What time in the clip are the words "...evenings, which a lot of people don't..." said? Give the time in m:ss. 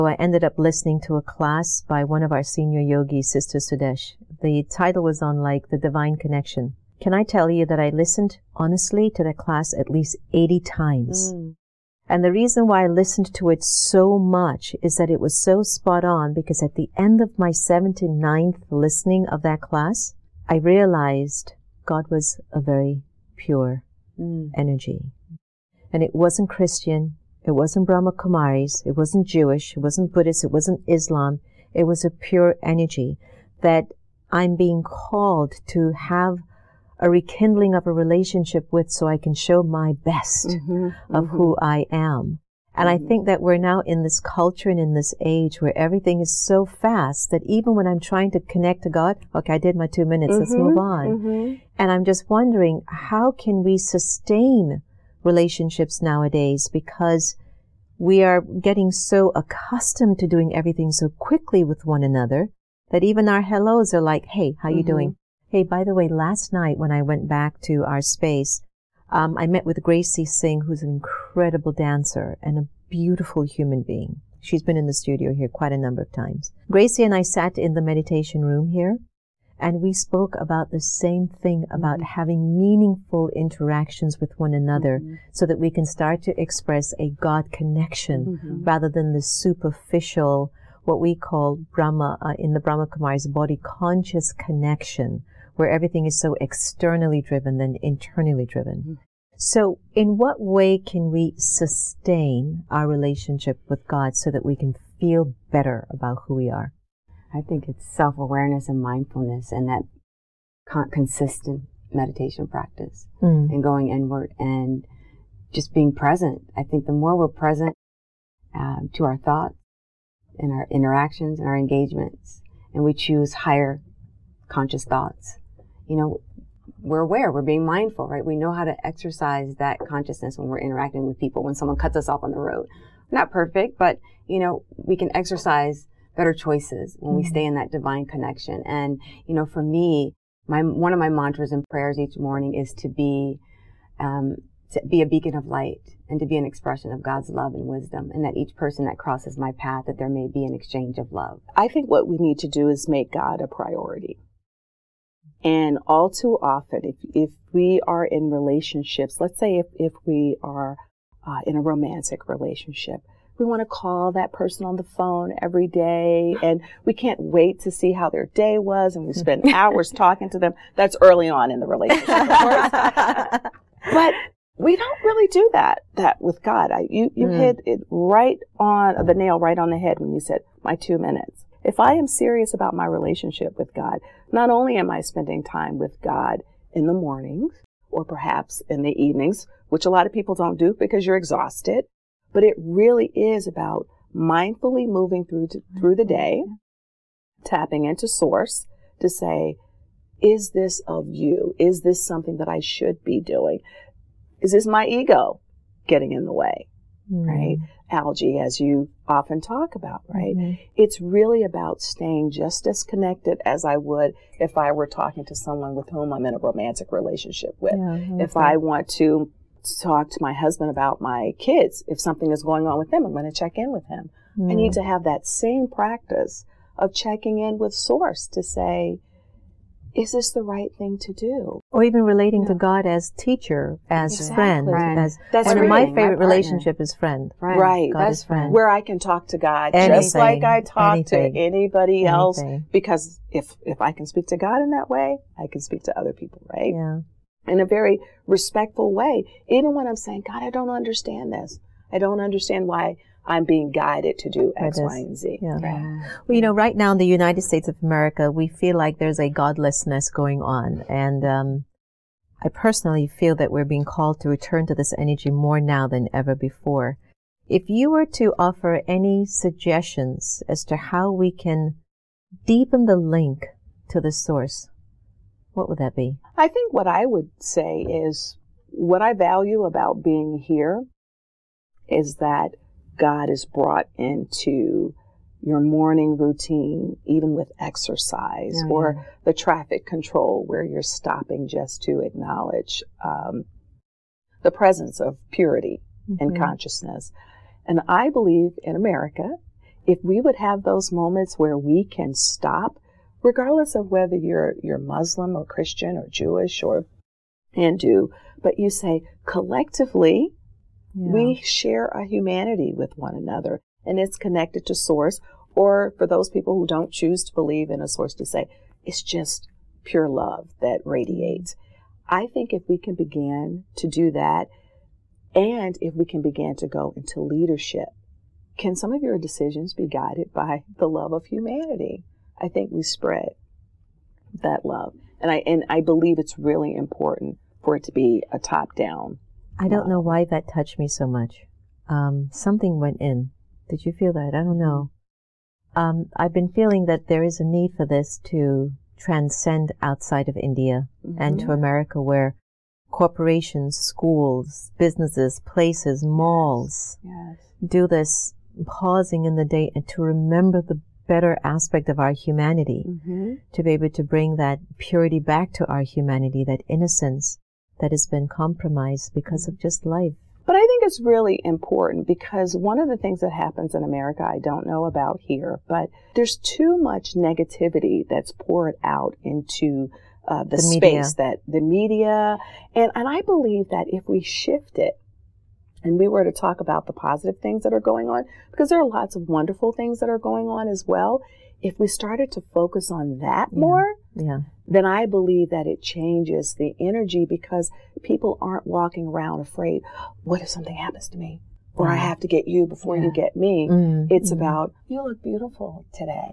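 3:09.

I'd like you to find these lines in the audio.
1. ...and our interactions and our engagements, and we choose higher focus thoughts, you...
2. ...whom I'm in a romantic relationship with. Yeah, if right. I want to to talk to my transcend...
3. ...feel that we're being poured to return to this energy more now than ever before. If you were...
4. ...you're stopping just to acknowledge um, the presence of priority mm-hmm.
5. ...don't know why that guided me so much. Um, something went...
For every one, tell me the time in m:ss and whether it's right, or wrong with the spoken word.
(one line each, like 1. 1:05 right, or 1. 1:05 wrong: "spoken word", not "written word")
1. 2:00 wrong: "conscious", not "focus"
2. 3:35 wrong: "husband", not "transcend"
3. 4:23 wrong: "called", not "poured"
4. 4:50 wrong: "purity", not "priority"
5. 5:39 wrong: "touched", not "guided".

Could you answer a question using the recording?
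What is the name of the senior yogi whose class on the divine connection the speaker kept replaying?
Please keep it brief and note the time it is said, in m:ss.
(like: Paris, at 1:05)
Sister Sudesh, at 0:03.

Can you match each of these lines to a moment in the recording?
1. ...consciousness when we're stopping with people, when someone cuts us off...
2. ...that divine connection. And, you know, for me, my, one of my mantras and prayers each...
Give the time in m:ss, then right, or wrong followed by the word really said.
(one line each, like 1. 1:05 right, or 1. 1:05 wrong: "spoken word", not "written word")
1. 2:09 wrong: "interacting", not "stopping"
2. 2:17 right.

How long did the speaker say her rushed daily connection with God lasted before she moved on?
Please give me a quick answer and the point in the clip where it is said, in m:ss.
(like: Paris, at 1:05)
2 minutes, at 0:49.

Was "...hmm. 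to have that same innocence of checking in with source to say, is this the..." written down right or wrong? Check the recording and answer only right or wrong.
wrong.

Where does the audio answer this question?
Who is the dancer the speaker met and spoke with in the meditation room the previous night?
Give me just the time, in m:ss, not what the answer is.
1:09.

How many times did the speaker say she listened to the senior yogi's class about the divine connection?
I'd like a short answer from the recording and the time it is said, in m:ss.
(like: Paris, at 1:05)
80, at 0:10.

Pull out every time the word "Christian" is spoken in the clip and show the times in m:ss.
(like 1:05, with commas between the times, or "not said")
0:26, 5:05.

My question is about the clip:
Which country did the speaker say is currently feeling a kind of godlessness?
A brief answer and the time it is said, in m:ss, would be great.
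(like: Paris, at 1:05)
United States of America, at 4:17.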